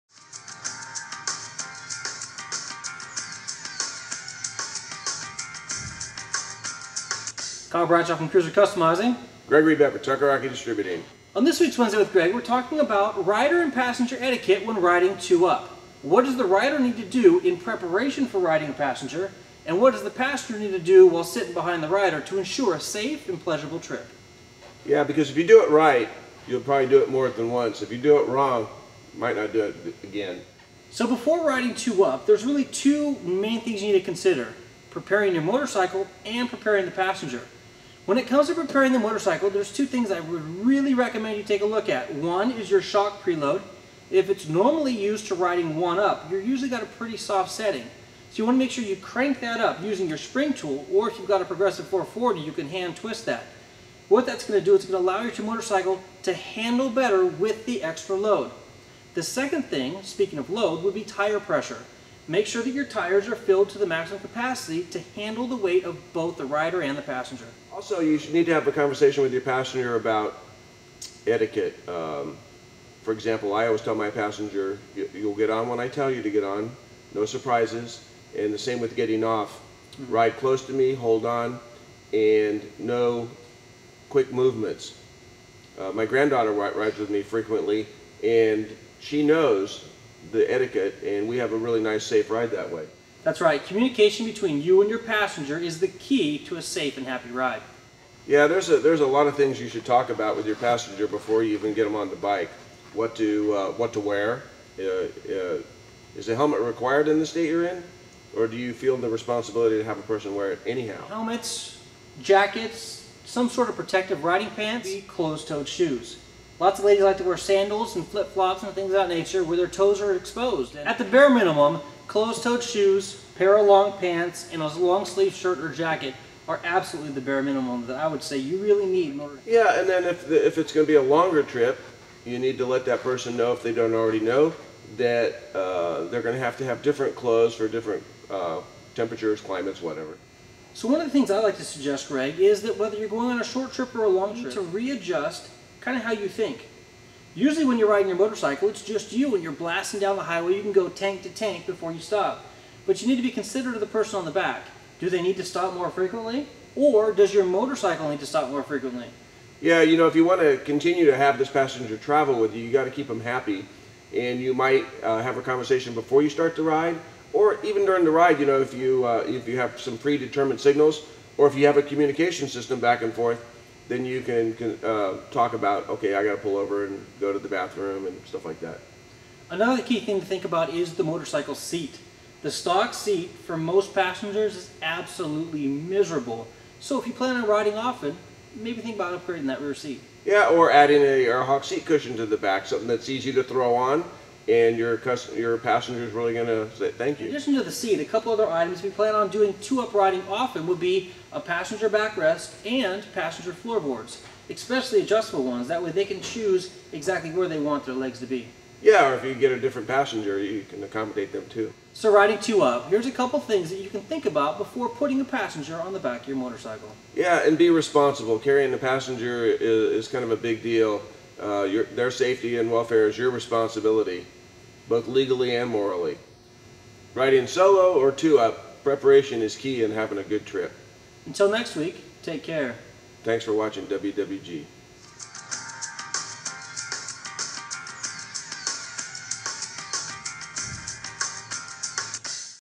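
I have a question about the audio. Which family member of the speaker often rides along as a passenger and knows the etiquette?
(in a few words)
Granddaughter.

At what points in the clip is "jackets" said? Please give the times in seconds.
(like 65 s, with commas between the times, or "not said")
112 s, 125 s.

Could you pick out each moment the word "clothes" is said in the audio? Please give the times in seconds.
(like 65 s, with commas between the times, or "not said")
137 s.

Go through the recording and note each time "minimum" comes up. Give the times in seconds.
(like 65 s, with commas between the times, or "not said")
121 s, 127 s.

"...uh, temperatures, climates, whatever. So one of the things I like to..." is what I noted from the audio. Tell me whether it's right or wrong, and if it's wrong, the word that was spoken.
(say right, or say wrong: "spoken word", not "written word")
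right.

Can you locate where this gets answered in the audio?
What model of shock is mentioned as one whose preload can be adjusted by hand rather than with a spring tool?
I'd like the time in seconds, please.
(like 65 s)
51 s.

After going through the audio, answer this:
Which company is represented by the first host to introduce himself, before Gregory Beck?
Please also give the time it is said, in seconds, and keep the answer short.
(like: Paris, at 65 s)
Cruiser Customizing, at 8 s.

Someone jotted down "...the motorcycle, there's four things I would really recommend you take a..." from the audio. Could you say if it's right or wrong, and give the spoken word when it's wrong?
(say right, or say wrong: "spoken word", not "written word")
wrong: "two", not "four".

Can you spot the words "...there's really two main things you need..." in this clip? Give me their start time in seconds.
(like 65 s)
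32 s.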